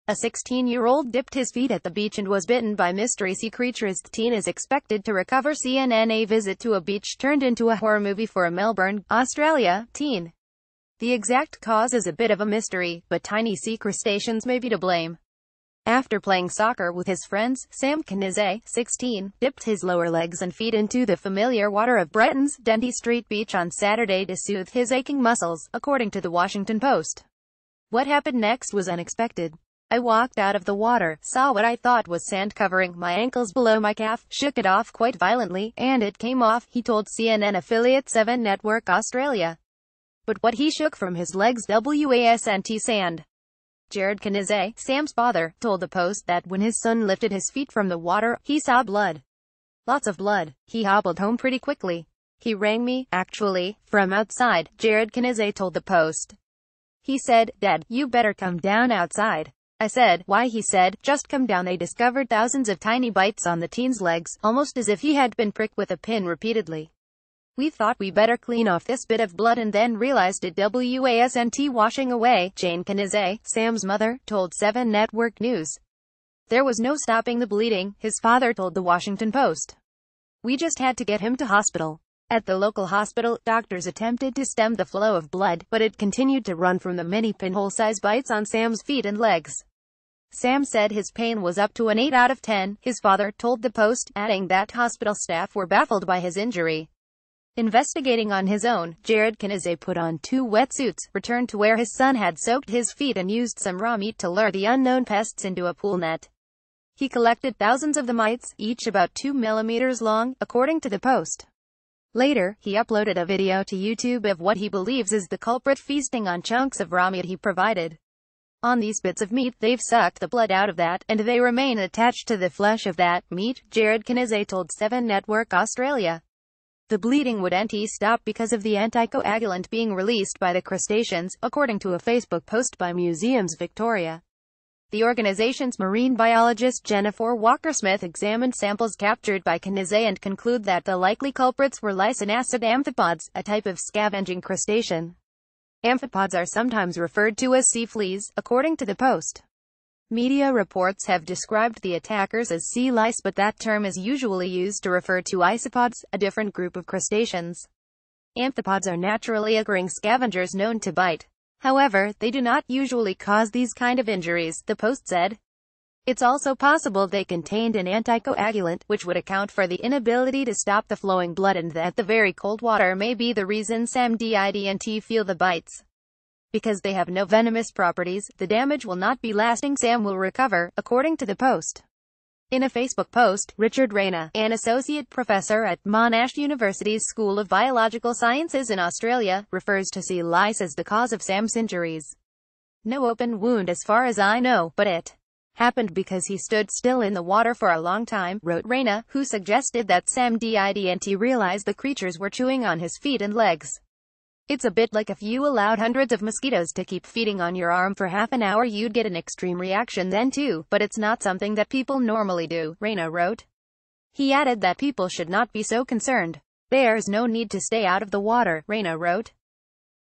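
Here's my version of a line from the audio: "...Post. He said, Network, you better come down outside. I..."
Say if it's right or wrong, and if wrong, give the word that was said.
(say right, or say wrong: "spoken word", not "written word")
wrong: "Dad", not "Network".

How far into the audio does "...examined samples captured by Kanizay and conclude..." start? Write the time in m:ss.
2:18.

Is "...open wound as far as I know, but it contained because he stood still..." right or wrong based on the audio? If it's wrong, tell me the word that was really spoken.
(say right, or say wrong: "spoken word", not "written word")
wrong: "happened", not "contained".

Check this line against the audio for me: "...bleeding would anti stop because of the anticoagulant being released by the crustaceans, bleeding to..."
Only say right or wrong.
wrong.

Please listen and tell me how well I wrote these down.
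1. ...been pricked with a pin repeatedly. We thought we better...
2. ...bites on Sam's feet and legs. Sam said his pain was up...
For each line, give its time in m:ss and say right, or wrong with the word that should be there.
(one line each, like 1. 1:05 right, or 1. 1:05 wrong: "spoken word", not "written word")
1. 1:05 right
2. 1:28 right.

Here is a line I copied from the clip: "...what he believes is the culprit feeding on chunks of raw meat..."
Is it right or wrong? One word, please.
wrong.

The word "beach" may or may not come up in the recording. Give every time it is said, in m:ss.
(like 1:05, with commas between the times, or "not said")
0:01, 0:06, 0:23.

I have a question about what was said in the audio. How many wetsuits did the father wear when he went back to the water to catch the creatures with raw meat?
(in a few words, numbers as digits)
2.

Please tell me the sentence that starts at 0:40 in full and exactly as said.
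But what he shook from his legs was sand.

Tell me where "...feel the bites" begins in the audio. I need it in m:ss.
2:55.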